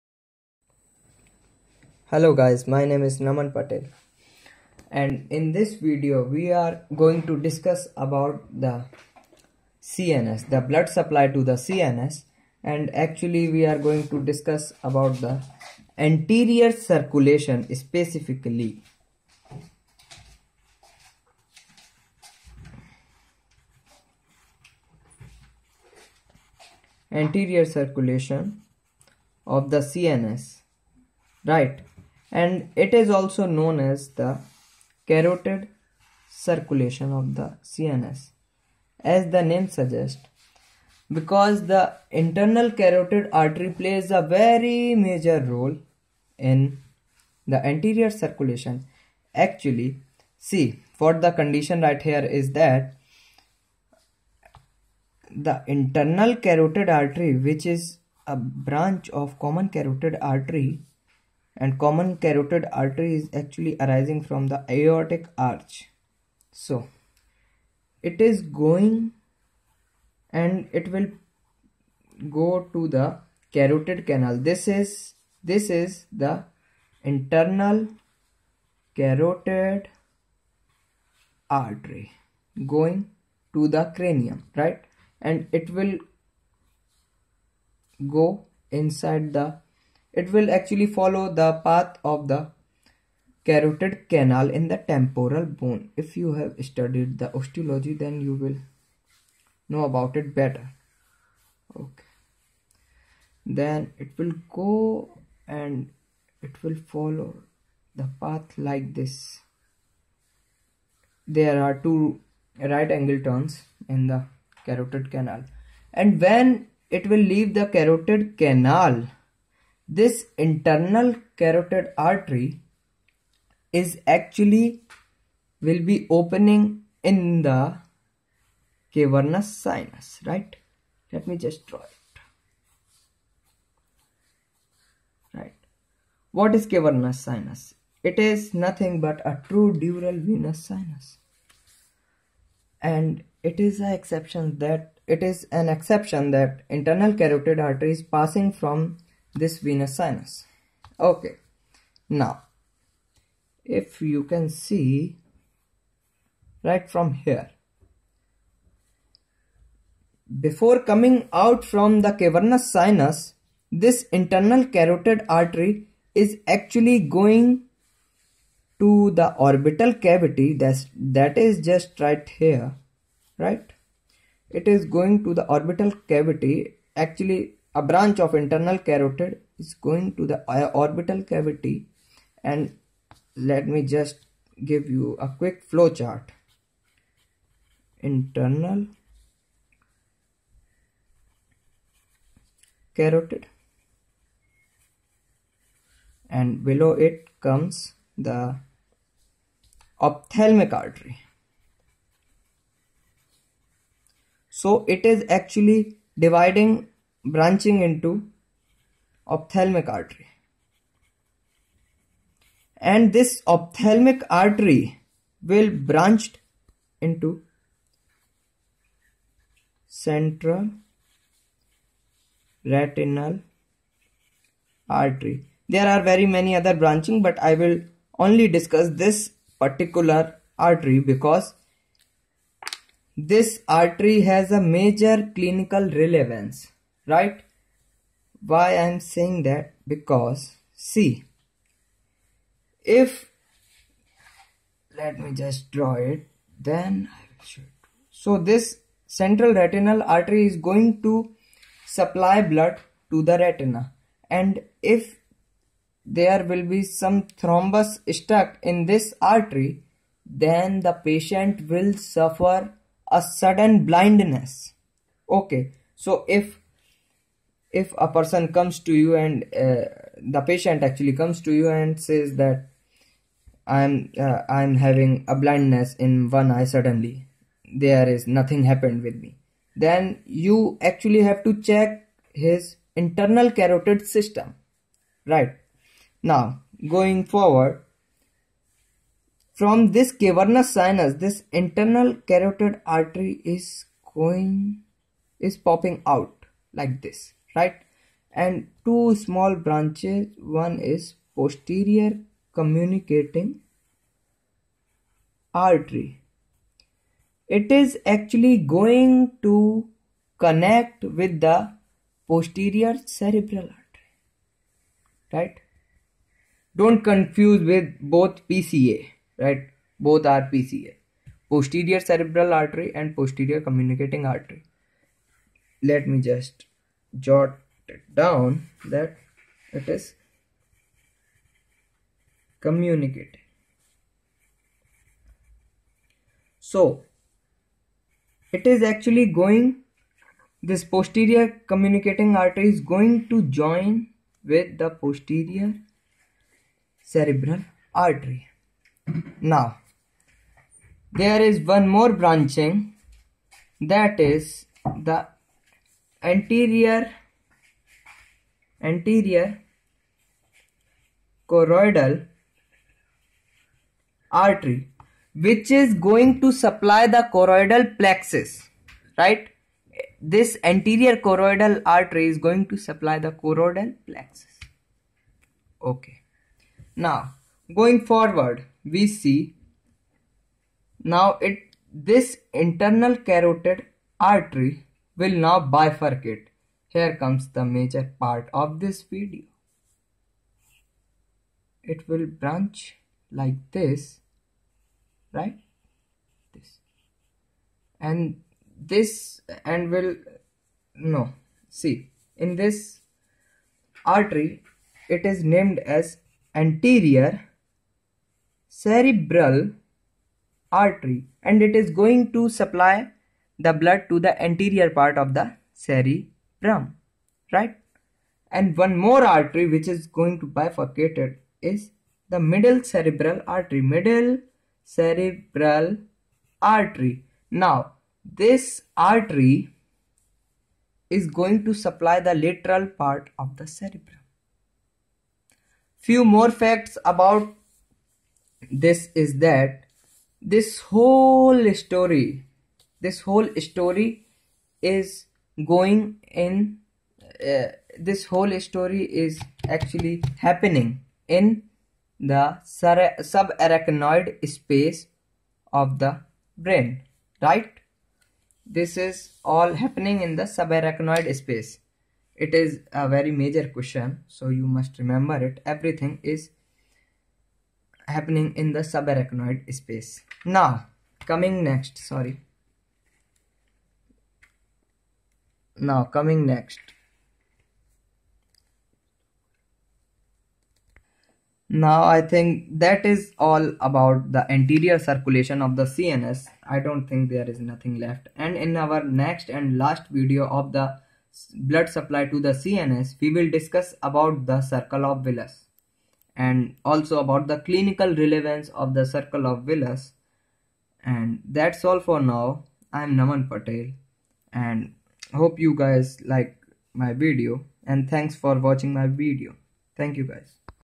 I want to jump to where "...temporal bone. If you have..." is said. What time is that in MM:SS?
01:34.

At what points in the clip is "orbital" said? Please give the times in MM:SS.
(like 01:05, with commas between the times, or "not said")
02:49, 02:55, 03:00.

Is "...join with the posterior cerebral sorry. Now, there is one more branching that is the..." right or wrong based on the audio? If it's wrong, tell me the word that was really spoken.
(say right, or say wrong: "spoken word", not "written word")
wrong: "artery", not "sorry".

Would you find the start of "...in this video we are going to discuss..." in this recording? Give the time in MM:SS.
00:05.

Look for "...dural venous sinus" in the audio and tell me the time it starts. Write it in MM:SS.
02:19.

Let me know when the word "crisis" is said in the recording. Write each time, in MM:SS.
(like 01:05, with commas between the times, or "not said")
not said.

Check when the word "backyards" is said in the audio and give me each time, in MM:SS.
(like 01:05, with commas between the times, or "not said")
not said.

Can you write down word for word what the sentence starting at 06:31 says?
It will branch like this, right?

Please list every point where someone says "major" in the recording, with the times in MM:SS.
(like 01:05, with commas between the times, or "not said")
00:44, 03:54, 06:27, 07:43.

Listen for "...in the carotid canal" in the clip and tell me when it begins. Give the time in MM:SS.
01:53.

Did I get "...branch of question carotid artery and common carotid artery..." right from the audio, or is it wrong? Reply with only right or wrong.
wrong.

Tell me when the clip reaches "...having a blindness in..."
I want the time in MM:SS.
04:34.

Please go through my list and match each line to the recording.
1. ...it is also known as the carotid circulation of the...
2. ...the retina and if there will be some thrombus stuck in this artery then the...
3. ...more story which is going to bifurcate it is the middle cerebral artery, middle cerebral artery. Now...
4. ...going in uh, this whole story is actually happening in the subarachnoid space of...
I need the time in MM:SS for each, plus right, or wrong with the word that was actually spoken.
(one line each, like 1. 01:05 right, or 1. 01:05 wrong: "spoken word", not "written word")
1. 00:32 right
2. 04:13 right
3. 06:58 wrong: "artery", not "story"
4. 07:25 right.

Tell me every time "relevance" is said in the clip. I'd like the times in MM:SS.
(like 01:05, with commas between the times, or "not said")
03:55, 08:18.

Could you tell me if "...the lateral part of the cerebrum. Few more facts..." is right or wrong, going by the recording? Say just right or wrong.
right.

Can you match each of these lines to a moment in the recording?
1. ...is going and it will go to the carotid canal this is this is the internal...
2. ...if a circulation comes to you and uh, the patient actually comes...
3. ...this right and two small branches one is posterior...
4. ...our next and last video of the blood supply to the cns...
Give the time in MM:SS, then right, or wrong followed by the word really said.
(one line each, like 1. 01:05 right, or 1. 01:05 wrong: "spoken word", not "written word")
1. 01:08 right
2. 04:27 wrong: "person", not "circulation"
3. 04:57 right
4. 08:08 right.